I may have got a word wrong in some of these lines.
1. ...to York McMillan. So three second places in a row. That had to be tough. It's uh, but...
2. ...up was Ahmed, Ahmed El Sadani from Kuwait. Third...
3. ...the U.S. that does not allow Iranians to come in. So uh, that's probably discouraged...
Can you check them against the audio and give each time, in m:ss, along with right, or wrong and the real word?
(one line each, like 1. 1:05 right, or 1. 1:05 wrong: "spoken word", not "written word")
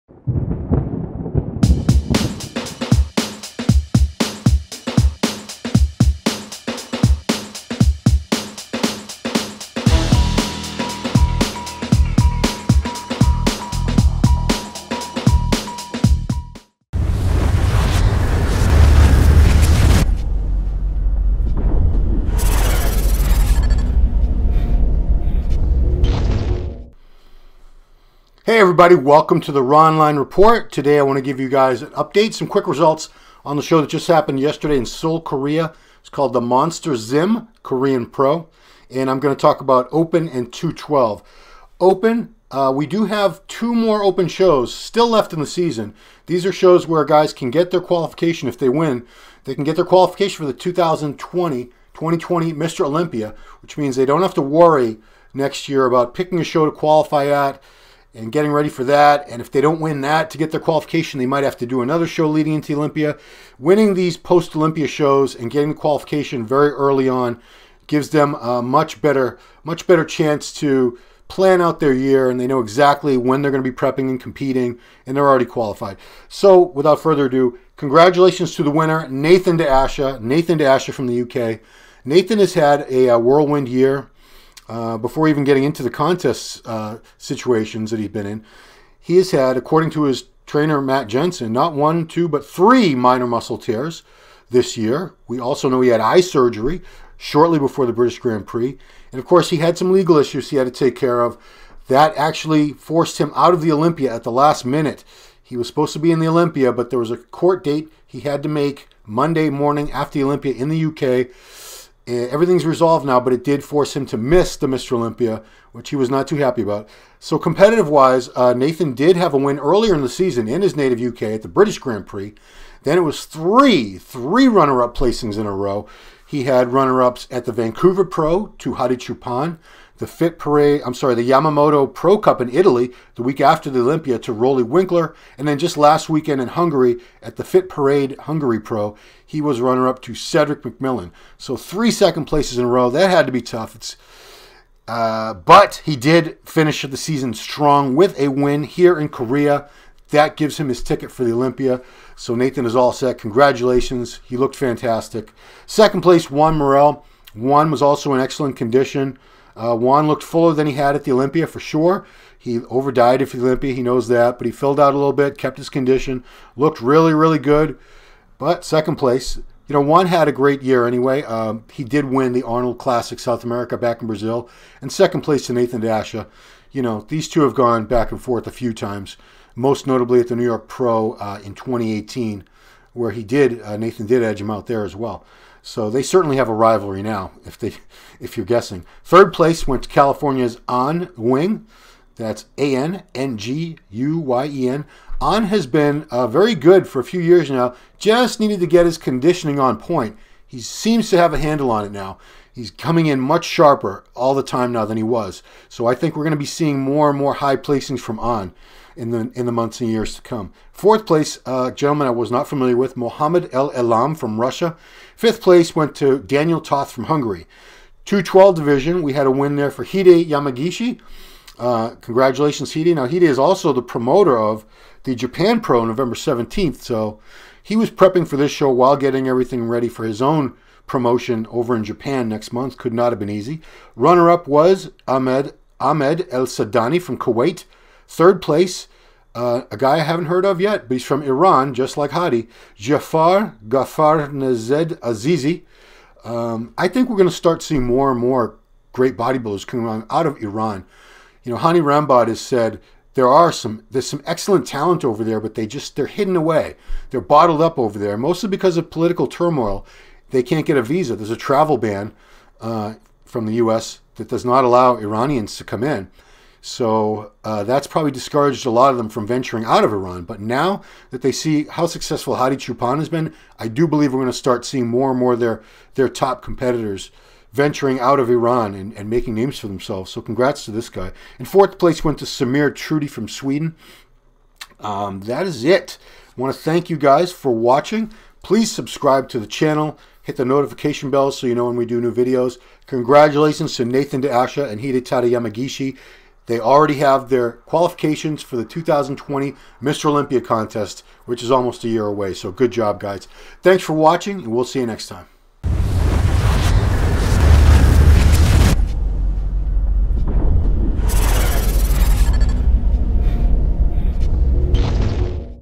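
1. 2:20 wrong: "Cedric", not "York"
2. 3:54 right
3. 4:23 right.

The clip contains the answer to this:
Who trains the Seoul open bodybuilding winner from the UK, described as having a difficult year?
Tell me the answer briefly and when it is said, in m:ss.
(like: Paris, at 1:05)
Matt Jensen, at 1:30.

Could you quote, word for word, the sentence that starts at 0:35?
It's called the Monster Zim Korean Pro, and I'm going to talk about Open and 212.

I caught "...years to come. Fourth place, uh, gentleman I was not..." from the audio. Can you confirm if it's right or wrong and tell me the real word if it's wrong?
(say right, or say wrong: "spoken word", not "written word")
right.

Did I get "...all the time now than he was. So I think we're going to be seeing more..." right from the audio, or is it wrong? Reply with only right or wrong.
right.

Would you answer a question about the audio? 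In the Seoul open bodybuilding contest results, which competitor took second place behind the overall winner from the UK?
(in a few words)
Juan Morel.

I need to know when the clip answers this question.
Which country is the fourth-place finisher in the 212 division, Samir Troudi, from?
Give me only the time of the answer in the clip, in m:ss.
4:43.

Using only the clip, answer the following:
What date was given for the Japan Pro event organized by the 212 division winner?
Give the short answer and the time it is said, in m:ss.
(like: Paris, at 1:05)
November 17th, at 3:45.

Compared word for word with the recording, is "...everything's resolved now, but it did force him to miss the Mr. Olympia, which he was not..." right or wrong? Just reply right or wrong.
right.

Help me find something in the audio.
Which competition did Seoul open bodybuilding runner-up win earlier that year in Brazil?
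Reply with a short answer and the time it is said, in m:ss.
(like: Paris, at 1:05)
Arnold Classic South America, at 2:52.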